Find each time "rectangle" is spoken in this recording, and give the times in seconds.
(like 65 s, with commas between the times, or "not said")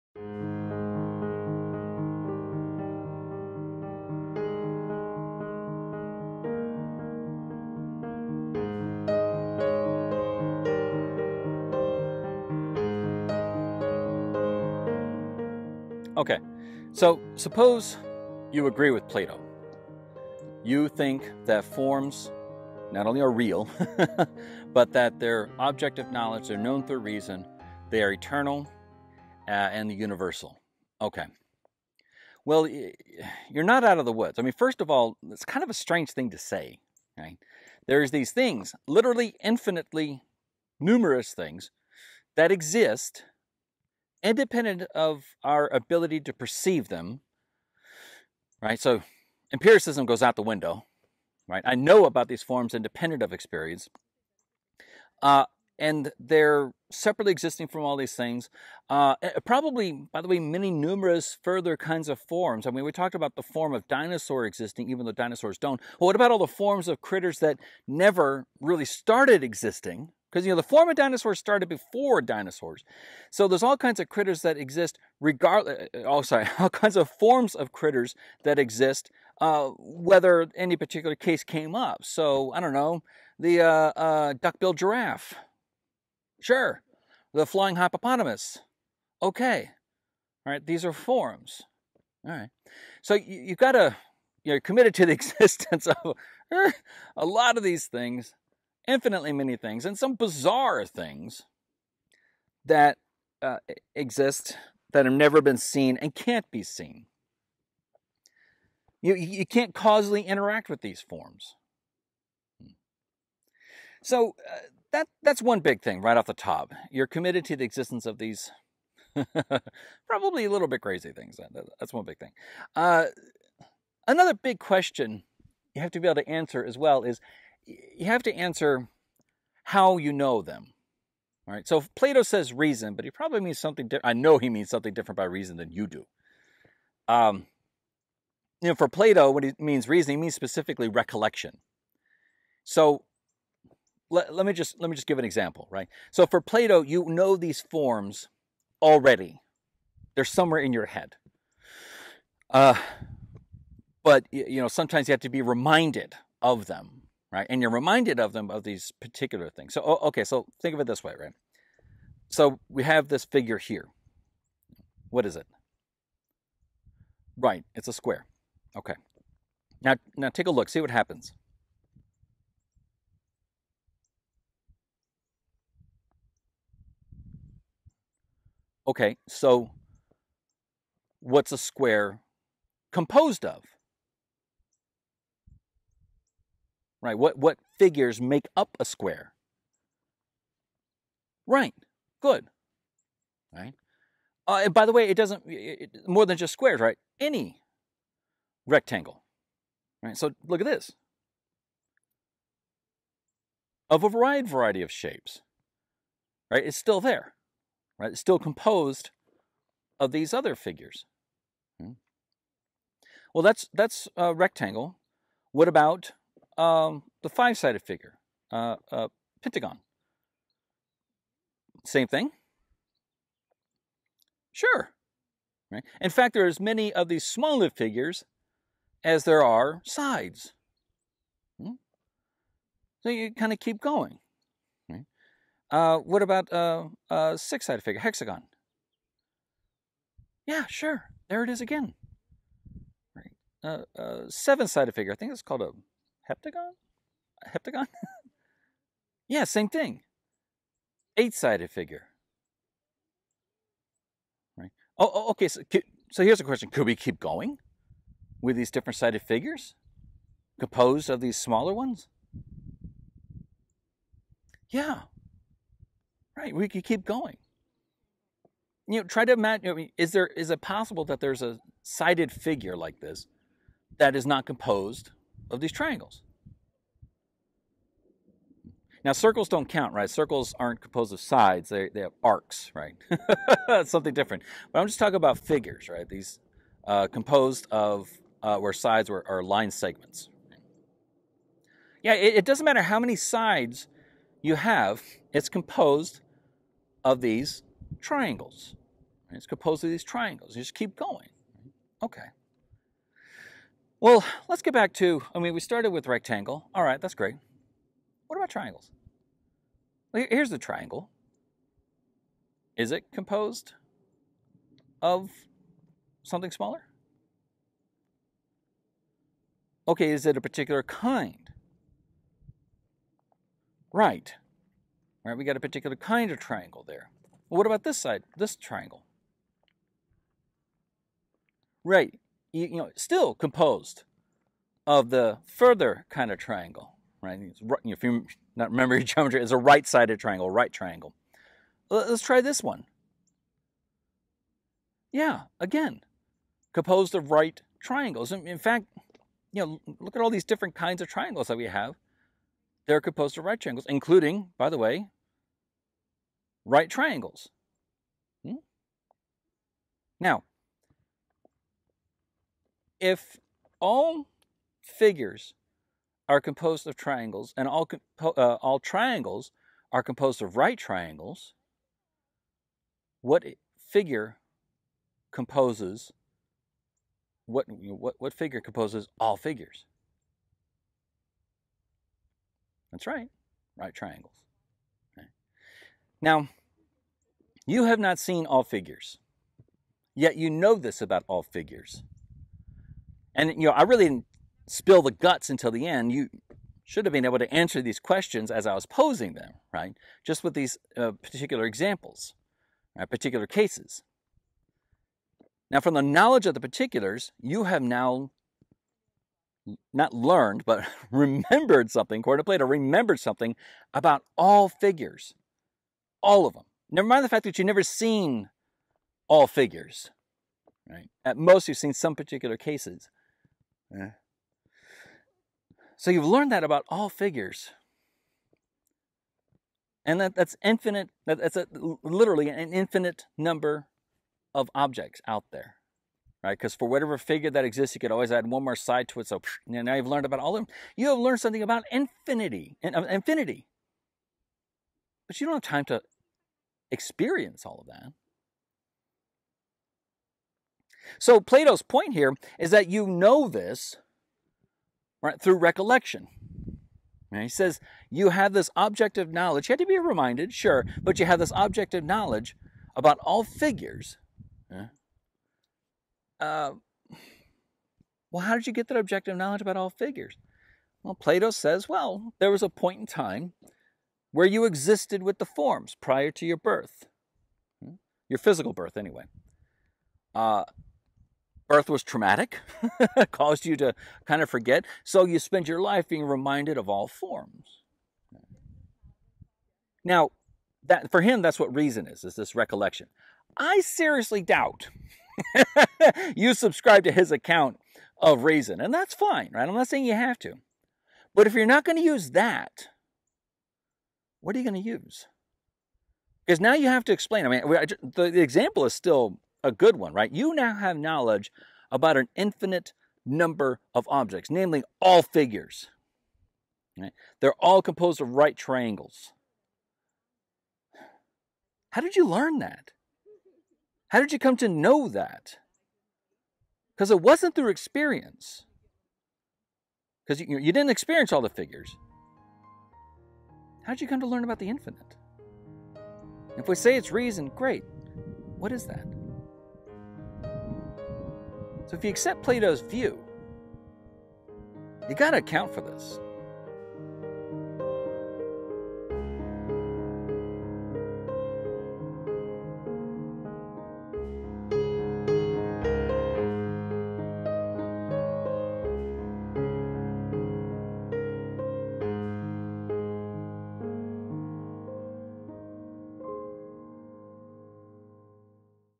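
198 s, 214 s, 306 s.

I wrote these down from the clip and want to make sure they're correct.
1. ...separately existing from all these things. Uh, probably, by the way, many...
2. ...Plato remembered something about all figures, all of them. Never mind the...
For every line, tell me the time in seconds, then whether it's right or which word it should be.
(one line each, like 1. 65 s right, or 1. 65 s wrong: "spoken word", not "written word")
1. 56 s right
2. 412 s right.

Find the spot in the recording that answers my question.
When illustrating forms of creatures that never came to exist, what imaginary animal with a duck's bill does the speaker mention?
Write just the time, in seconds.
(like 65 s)
84 s.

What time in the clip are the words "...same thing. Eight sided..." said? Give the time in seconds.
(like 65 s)
249 s.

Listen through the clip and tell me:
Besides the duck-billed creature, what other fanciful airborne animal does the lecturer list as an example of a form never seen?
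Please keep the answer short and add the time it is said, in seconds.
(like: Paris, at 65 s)
flying hippopotamus, at 87 s.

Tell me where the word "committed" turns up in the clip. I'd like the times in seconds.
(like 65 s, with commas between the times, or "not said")
94 s, 117 s.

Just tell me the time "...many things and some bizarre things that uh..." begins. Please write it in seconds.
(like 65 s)
99 s.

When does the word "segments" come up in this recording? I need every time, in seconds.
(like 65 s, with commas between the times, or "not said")
289 s.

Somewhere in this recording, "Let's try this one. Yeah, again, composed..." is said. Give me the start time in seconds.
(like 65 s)
341 s.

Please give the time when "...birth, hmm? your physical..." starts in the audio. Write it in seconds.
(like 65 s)
476 s.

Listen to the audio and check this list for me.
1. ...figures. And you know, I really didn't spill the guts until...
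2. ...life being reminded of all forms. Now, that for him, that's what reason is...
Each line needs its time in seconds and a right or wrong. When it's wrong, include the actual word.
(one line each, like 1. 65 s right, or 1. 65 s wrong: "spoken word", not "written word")
1. 391 s right
2. 485 s right.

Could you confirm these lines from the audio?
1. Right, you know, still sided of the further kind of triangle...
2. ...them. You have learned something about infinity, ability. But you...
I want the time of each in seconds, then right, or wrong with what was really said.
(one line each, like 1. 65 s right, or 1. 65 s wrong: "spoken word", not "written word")
1. 331 s wrong: "composed", not "sided"
2. 440 s wrong: "infinity", not "ability".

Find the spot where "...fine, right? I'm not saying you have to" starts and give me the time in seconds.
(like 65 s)
499 s.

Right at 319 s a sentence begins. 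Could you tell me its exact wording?
Okay, is it a particular kind?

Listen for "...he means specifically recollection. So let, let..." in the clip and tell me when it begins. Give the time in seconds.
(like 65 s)
140 s.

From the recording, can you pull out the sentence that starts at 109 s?
You, you can't causally interact with these forms.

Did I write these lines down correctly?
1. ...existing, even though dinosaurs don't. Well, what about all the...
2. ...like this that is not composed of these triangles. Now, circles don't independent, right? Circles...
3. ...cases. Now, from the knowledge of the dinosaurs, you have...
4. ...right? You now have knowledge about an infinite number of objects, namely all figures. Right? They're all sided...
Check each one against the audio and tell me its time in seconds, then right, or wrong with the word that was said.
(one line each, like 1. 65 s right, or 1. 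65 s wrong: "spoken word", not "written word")
1. 64 s right
2. 272 s wrong: "count", not "independent"
3. 403 s wrong: "particulars", not "dinosaurs"
4. 510 s wrong: "composed", not "sided".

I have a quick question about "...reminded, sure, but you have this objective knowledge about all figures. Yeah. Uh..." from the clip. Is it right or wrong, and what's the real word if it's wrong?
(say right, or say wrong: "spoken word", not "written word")
right.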